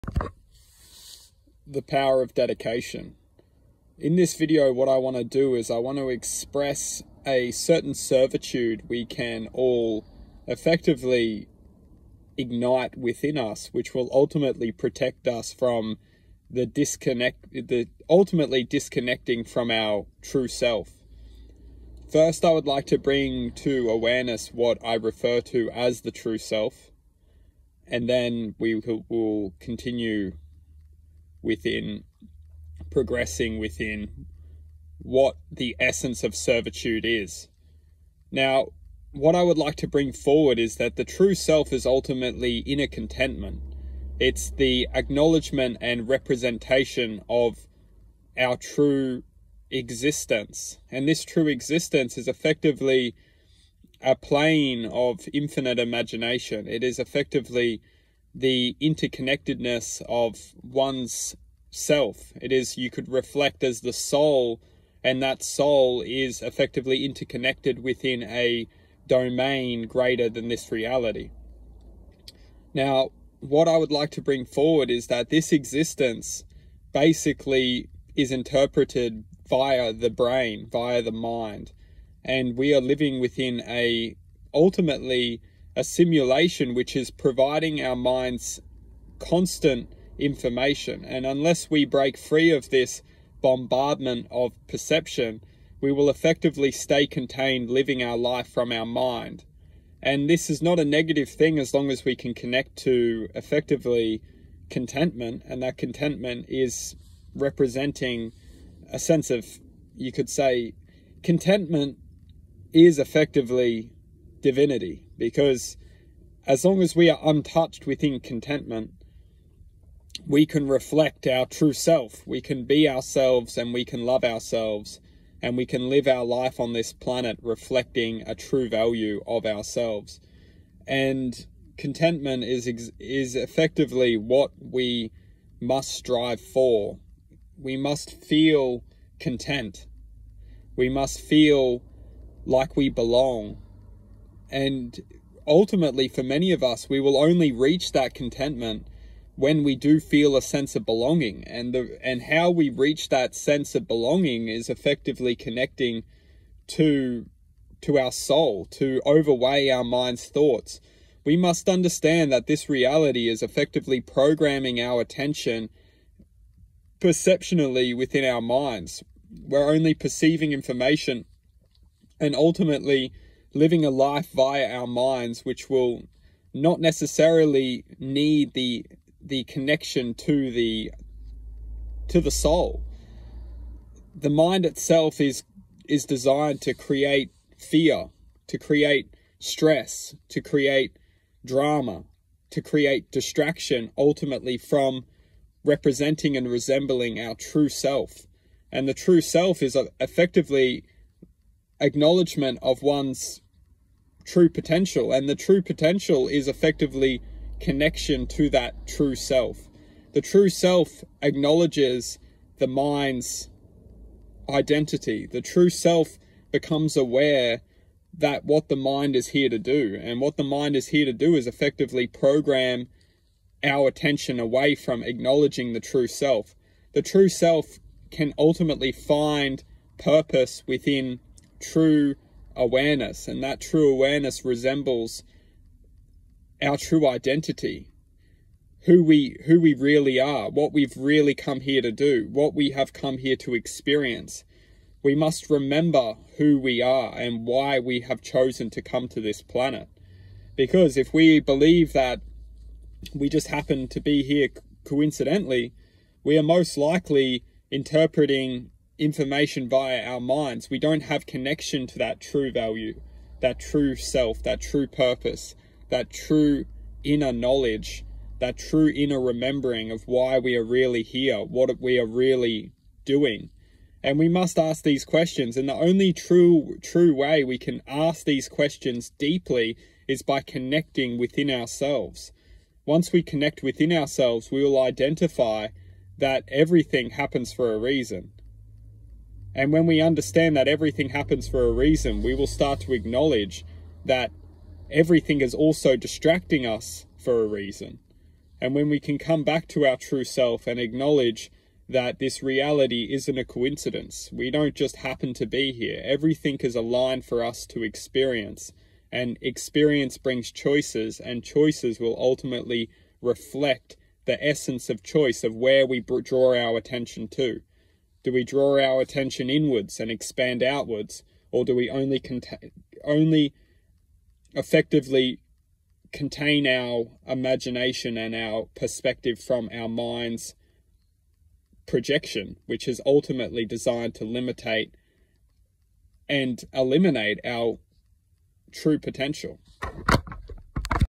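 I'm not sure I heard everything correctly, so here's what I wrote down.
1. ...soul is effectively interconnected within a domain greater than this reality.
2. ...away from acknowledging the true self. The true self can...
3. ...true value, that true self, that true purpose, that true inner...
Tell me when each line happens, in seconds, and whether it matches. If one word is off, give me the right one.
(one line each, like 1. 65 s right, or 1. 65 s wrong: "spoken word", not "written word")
1. 65 s right
2. 224 s right
3. 262 s right.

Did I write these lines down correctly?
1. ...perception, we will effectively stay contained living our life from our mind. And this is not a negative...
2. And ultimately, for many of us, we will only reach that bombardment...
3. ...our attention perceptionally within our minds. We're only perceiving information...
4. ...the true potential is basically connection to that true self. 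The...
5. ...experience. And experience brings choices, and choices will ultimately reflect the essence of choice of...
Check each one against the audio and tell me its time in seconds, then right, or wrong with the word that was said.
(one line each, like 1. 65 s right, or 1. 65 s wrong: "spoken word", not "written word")
1. 94 s right
2. 144 s wrong: "contentment", not "bombardment"
3. 164 s right
4. 205 s wrong: "effectively", not "basically"
5. 307 s right.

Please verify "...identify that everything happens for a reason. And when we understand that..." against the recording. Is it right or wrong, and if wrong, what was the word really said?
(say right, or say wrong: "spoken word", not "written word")
right.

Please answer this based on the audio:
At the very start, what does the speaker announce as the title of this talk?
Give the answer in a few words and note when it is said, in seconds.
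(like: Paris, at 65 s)
The power of dedication, at 1 s.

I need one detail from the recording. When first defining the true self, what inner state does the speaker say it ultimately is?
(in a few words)
Inner contentment.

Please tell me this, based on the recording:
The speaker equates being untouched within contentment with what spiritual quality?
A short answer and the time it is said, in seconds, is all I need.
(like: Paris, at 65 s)
Divinity, at 114 s.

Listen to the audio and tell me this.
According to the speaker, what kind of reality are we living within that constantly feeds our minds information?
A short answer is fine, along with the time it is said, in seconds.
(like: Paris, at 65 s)
A simulation, at 85 s.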